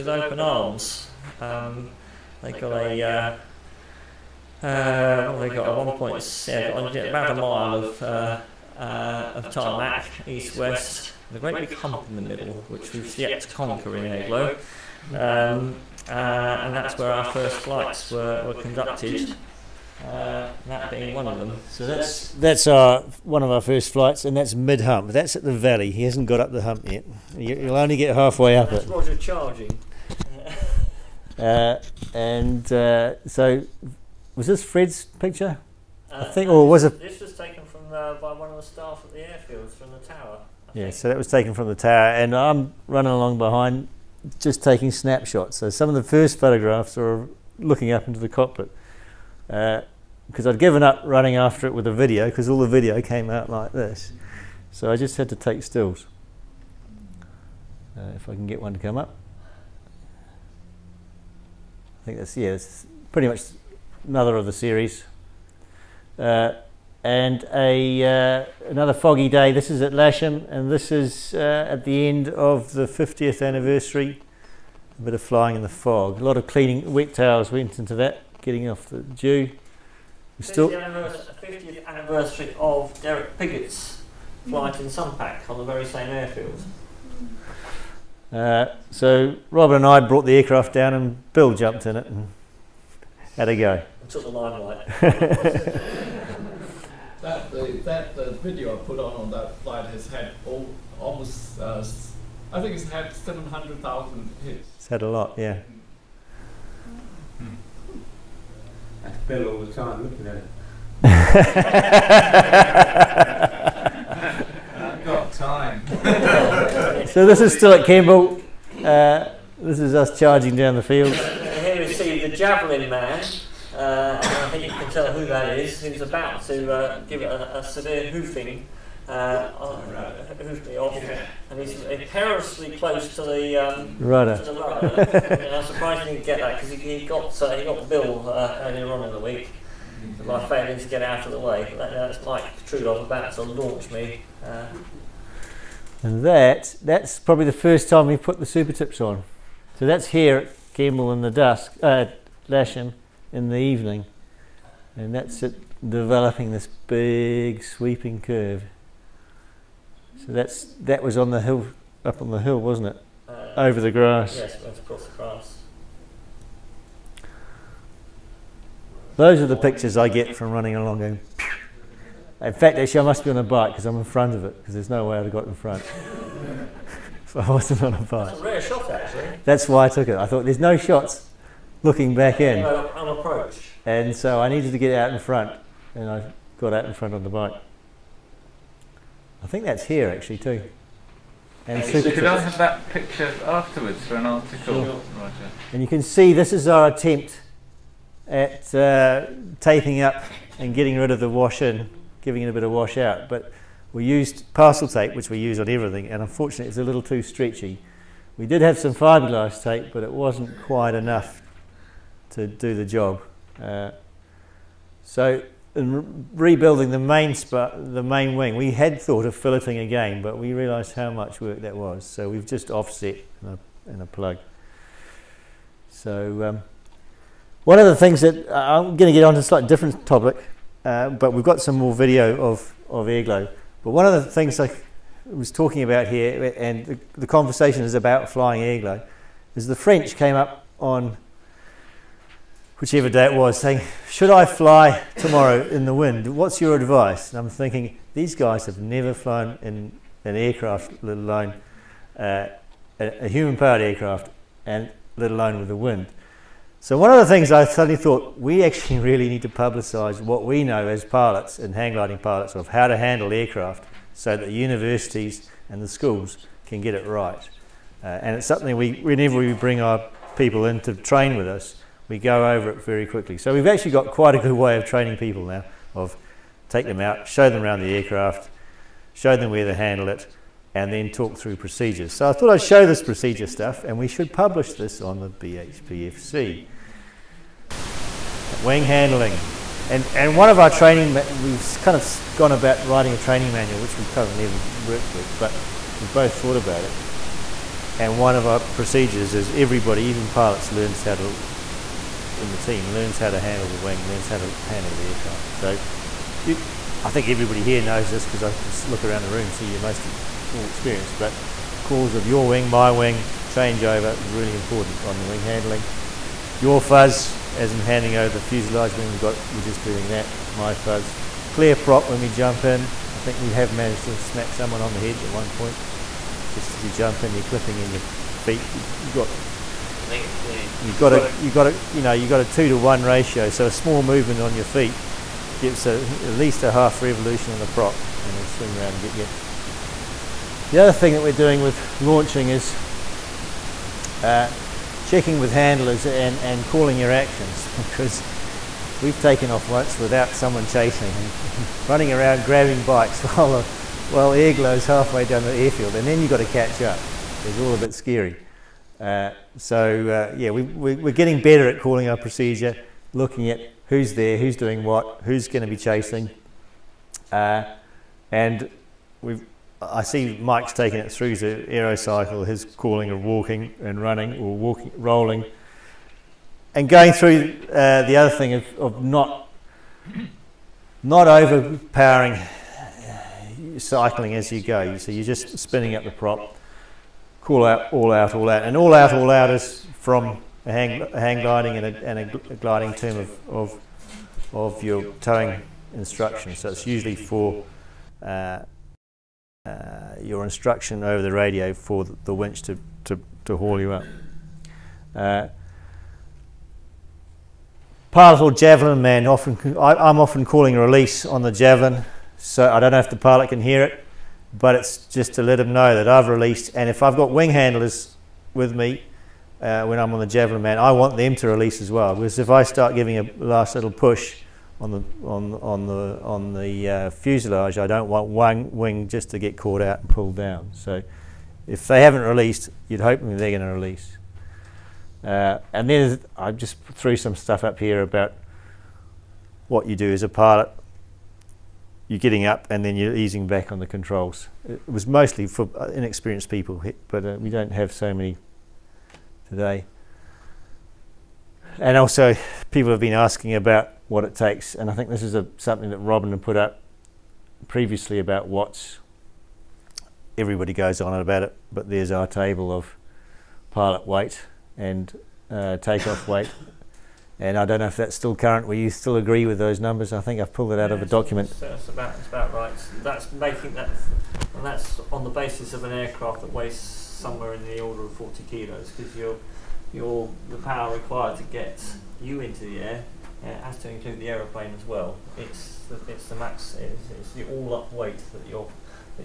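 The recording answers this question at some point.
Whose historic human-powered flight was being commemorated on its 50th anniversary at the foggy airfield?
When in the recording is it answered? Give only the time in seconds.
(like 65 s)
83 s.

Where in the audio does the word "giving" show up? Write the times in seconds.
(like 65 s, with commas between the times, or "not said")
202 s, 422 s.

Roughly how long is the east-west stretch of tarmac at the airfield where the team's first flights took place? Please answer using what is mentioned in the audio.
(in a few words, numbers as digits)
about a mile.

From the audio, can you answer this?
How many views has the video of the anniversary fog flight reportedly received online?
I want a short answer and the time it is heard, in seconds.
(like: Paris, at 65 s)
700,000, at 103 s.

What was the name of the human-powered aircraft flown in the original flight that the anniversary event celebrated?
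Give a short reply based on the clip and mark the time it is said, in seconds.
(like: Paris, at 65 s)
SUMPAC, at 84 s.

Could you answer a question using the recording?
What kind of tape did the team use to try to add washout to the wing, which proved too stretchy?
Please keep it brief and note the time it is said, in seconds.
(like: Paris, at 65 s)
parcel tape, at 204 s.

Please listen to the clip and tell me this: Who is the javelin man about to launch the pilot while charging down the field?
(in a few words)
Mike Truelove.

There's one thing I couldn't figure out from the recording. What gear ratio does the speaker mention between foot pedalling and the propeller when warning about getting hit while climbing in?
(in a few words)
2 to 1.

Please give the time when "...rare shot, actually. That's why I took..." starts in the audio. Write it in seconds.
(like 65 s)
178 s.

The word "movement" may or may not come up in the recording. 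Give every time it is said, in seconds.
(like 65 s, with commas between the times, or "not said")
334 s.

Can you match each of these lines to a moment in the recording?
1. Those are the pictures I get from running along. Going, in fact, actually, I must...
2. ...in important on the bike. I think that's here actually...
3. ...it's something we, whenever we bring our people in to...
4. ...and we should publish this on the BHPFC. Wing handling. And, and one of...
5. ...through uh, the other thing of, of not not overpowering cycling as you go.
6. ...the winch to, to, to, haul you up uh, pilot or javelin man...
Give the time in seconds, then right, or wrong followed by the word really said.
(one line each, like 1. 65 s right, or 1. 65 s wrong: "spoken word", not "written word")
1. 169 s right
2. 186 s wrong: "front", not "important"
3. 268 s right
4. 283 s right
5. 377 s right
6. 402 s right.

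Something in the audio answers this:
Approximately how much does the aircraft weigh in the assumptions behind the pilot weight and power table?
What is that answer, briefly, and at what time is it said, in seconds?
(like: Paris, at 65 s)
40 kilos, at 478 s.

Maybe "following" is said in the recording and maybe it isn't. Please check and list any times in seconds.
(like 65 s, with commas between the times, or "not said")
not said.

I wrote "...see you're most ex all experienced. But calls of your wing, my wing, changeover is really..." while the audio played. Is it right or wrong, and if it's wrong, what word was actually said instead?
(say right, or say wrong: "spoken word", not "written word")
right.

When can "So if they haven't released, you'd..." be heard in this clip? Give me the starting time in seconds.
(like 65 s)
430 s.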